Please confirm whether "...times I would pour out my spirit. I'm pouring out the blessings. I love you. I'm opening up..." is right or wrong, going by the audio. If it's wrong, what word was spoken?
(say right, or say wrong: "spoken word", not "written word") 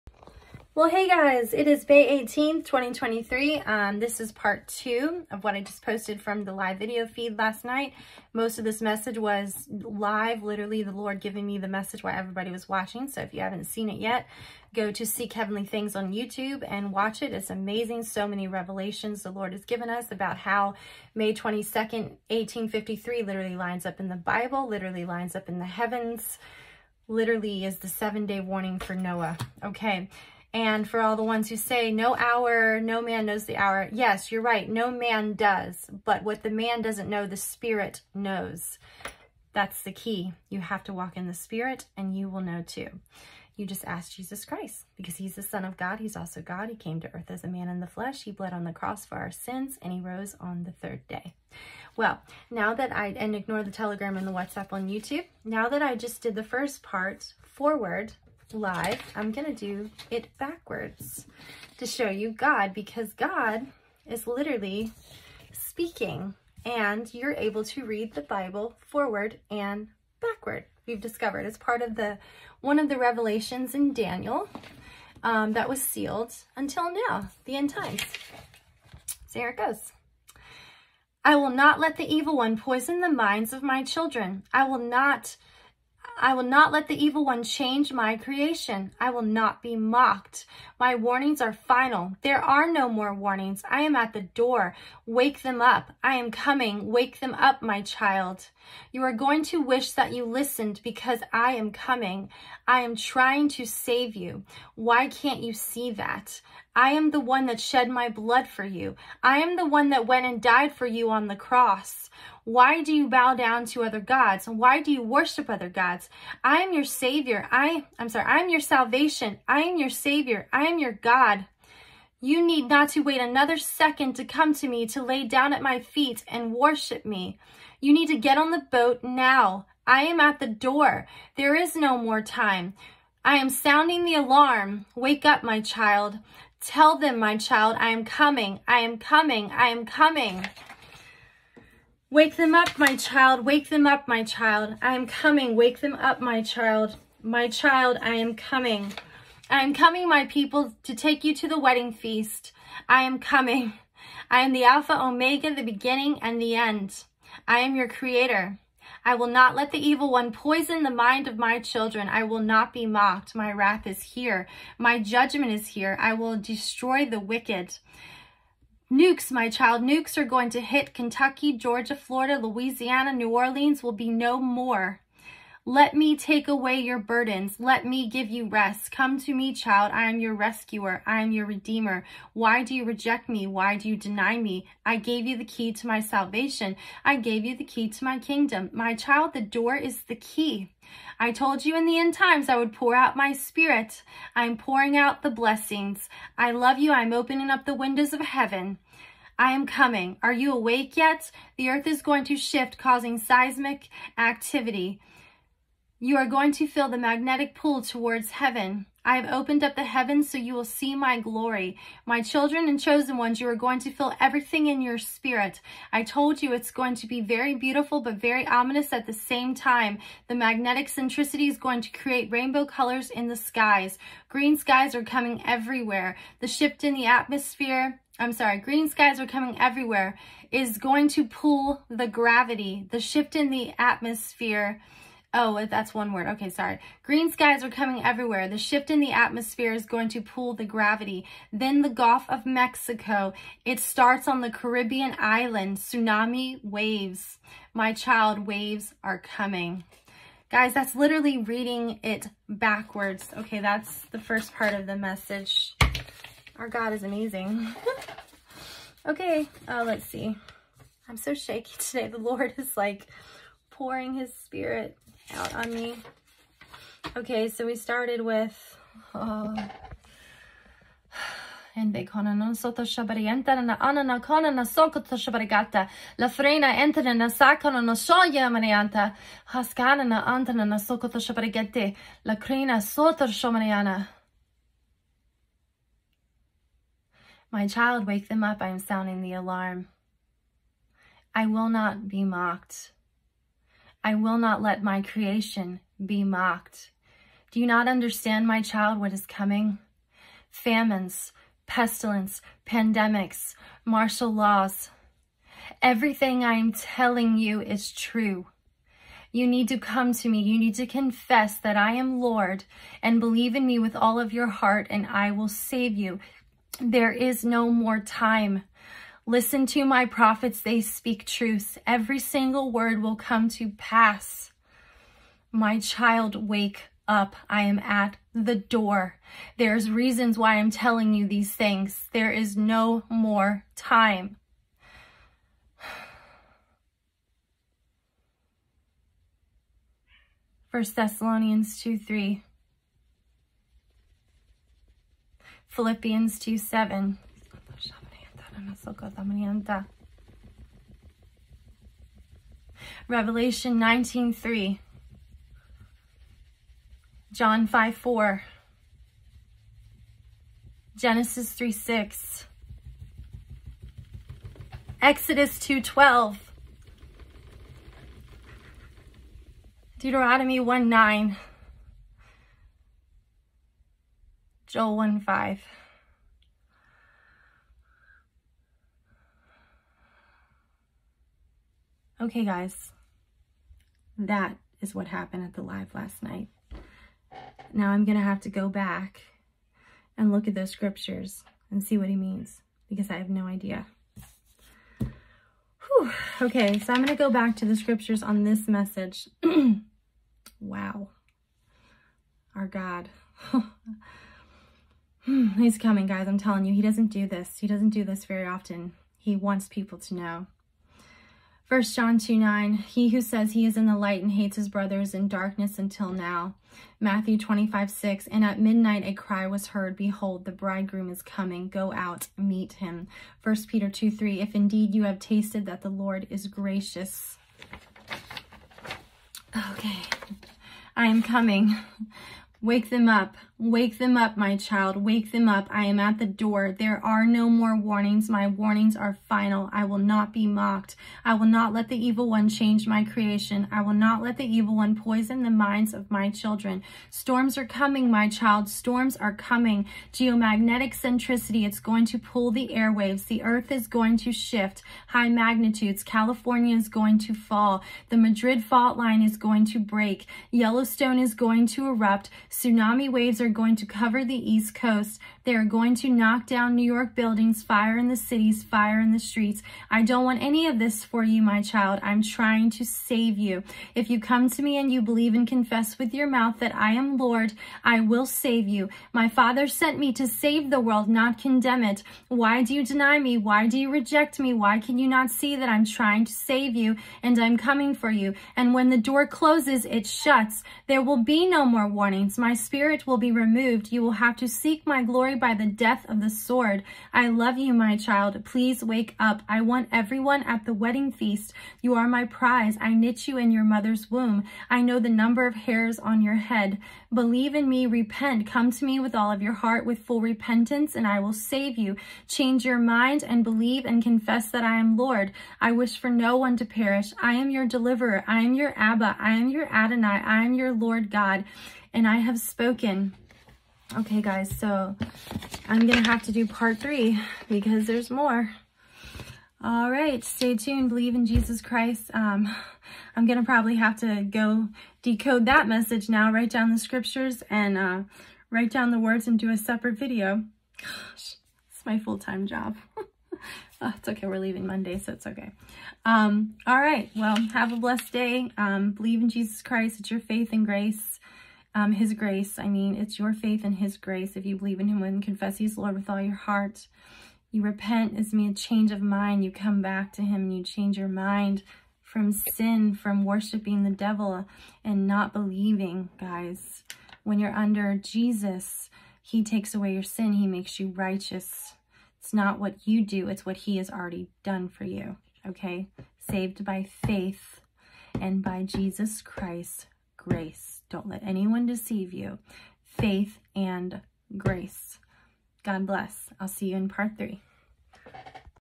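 right.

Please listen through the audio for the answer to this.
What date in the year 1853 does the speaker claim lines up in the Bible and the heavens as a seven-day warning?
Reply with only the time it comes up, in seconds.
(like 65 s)
21 s.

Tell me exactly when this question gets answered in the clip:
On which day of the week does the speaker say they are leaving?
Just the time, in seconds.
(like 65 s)
544 s.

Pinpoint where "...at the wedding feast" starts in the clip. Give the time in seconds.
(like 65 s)
500 s.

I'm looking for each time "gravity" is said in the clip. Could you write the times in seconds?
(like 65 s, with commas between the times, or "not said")
232 s, 240 s.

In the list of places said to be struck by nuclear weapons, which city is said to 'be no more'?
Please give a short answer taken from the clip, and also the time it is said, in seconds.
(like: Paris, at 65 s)
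New Orleans, at 173 s.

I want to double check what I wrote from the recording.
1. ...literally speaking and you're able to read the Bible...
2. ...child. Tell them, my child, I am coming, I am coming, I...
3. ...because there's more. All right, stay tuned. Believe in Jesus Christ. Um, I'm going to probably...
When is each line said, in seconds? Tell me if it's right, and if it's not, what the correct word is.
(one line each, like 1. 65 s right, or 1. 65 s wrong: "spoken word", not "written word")
1. 64 s right
2. 135 s right
3. 527 s right.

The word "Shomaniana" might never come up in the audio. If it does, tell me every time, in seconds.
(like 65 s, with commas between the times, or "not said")
283 s.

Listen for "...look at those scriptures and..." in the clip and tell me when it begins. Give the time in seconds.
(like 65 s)
390 s.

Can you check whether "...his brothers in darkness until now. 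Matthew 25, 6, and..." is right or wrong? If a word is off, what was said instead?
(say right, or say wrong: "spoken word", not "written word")
right.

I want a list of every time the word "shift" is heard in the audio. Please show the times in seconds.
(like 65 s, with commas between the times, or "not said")
202 s, 226 s, 232 s, 238 s, 454 s.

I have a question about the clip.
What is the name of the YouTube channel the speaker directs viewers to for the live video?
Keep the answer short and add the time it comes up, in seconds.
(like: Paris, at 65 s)
Seek Heavenly Things, at 15 s.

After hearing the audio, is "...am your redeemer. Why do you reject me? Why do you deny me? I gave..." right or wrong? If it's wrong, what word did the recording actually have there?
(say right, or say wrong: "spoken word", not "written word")
right.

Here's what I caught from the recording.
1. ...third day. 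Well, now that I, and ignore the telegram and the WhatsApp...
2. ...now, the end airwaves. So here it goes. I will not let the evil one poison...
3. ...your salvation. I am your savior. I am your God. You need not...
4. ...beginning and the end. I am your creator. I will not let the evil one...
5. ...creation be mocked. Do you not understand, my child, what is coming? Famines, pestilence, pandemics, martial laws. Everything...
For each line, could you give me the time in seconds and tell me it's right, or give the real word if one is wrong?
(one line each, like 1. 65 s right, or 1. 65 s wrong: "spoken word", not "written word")
1. 50 s right
2. 77 s wrong: "times", not "airwaves"
3. 118 s right
4. 155 s right
5. 295 s right.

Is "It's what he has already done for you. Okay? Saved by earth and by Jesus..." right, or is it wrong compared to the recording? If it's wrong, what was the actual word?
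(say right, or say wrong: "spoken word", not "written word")
wrong: "faith", not "earth".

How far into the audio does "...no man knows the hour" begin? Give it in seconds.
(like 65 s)
32 s.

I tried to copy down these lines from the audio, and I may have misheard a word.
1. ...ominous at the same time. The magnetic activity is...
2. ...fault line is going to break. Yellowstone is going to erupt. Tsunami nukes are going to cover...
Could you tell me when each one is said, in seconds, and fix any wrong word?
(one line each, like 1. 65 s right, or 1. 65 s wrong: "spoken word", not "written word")
1. 218 s wrong: "centricity", not "activity"
2. 458 s wrong: "waves", not "nukes".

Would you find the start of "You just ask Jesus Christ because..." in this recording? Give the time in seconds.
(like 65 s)
43 s.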